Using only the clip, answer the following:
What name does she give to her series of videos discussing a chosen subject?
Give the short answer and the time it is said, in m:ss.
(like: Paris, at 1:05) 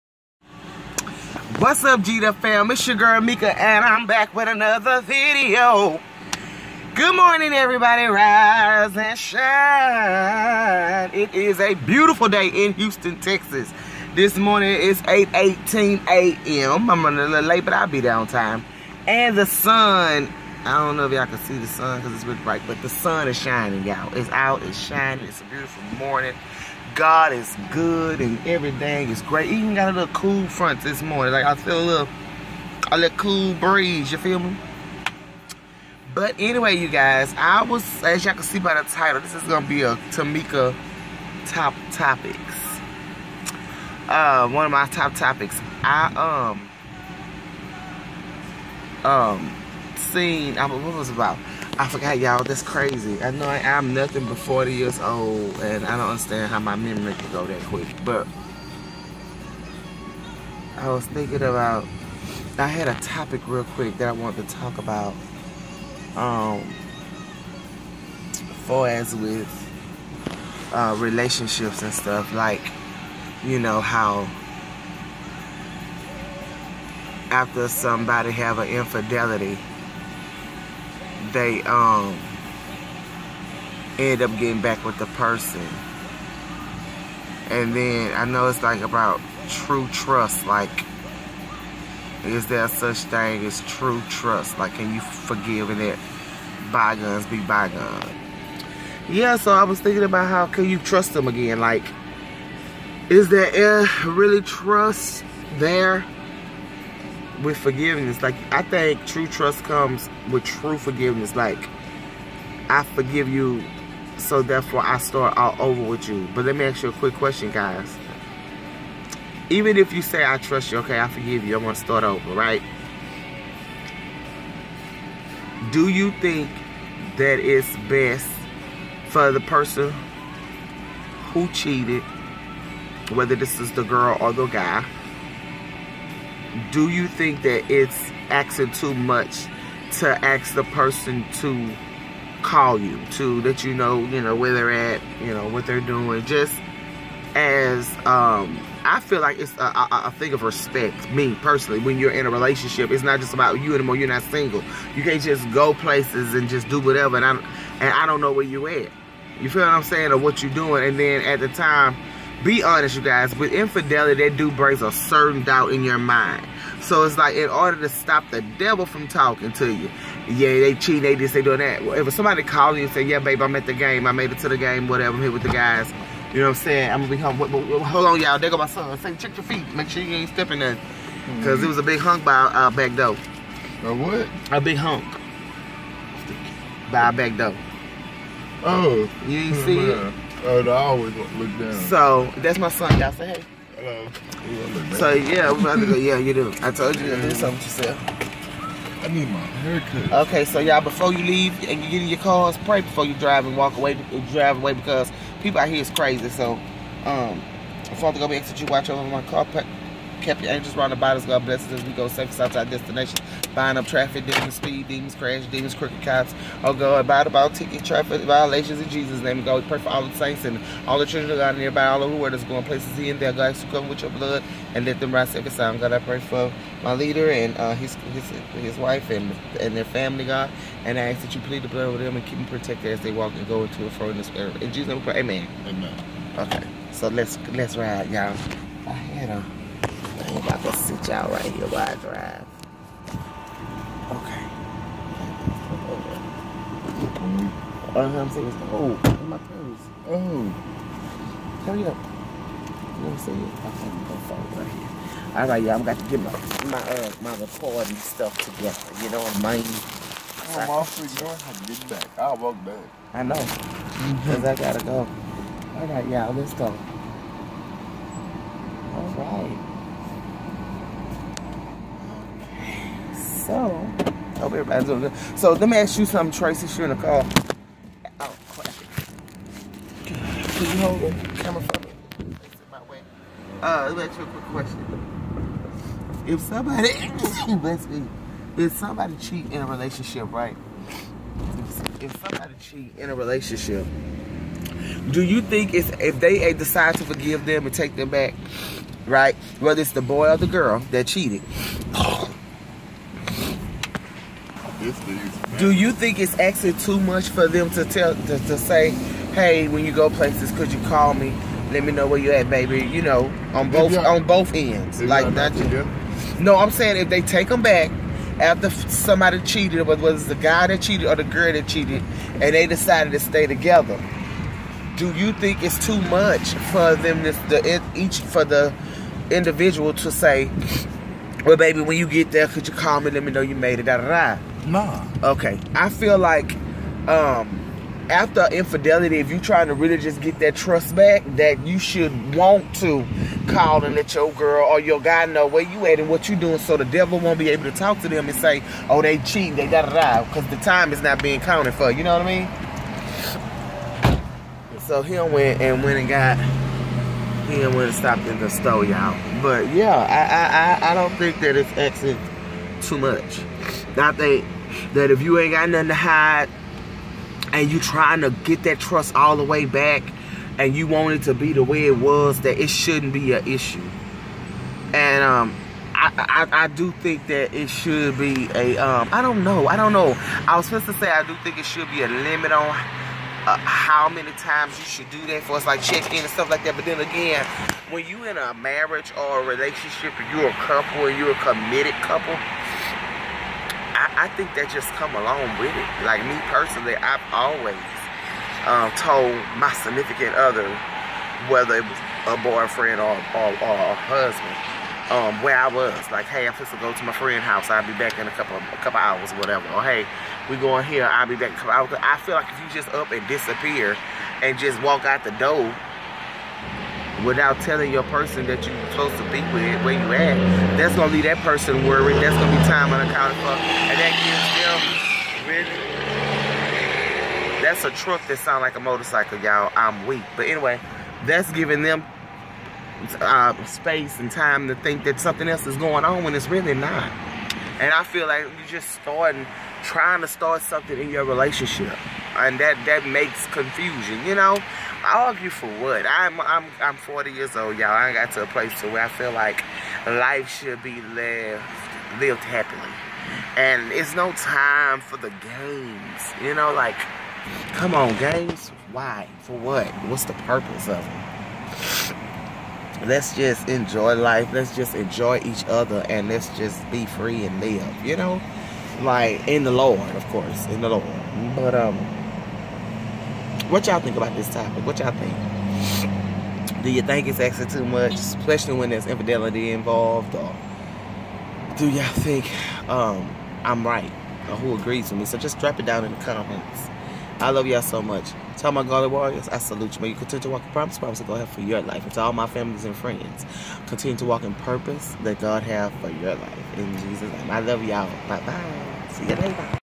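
Tameka top topics, at 0:40.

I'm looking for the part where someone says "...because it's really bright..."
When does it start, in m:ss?
0:22.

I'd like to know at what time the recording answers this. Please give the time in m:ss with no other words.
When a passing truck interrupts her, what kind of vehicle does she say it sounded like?
7:08.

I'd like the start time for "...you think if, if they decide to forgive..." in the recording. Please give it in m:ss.
4:55.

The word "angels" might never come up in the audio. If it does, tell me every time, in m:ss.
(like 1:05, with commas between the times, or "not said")
3:30.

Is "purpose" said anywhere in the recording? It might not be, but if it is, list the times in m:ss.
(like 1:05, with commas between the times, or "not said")
7:40, 8:14.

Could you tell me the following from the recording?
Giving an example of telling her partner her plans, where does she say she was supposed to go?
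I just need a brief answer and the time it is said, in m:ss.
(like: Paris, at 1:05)
friend's house, at 6:47.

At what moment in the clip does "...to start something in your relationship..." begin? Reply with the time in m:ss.
7:20.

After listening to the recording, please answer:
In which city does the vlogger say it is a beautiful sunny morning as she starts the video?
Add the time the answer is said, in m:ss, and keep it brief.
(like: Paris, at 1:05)
Houston, Texas, at 0:12.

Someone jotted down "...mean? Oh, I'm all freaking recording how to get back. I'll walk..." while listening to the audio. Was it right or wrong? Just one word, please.
wrong.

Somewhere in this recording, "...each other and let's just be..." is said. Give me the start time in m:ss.
7:45.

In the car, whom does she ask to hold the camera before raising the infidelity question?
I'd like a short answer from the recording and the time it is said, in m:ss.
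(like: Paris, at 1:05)
Tracy, at 4:36.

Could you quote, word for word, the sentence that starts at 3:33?
Bind up traffic, demons, speed, demons, crash, demons, crooked cops.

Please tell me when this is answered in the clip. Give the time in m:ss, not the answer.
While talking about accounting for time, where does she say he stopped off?
5:58.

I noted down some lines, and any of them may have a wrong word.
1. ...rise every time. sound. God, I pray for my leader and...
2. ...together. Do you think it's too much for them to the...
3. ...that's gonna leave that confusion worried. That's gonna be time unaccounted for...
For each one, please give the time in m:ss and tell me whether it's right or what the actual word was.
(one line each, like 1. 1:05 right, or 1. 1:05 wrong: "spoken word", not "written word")
1. 3:45 right
2. 5:23 right
3. 7:00 wrong: "person", not "confusion".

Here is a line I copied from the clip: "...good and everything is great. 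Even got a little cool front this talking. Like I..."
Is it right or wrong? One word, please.
wrong.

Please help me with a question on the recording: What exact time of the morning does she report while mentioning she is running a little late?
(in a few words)
8:18 a.m.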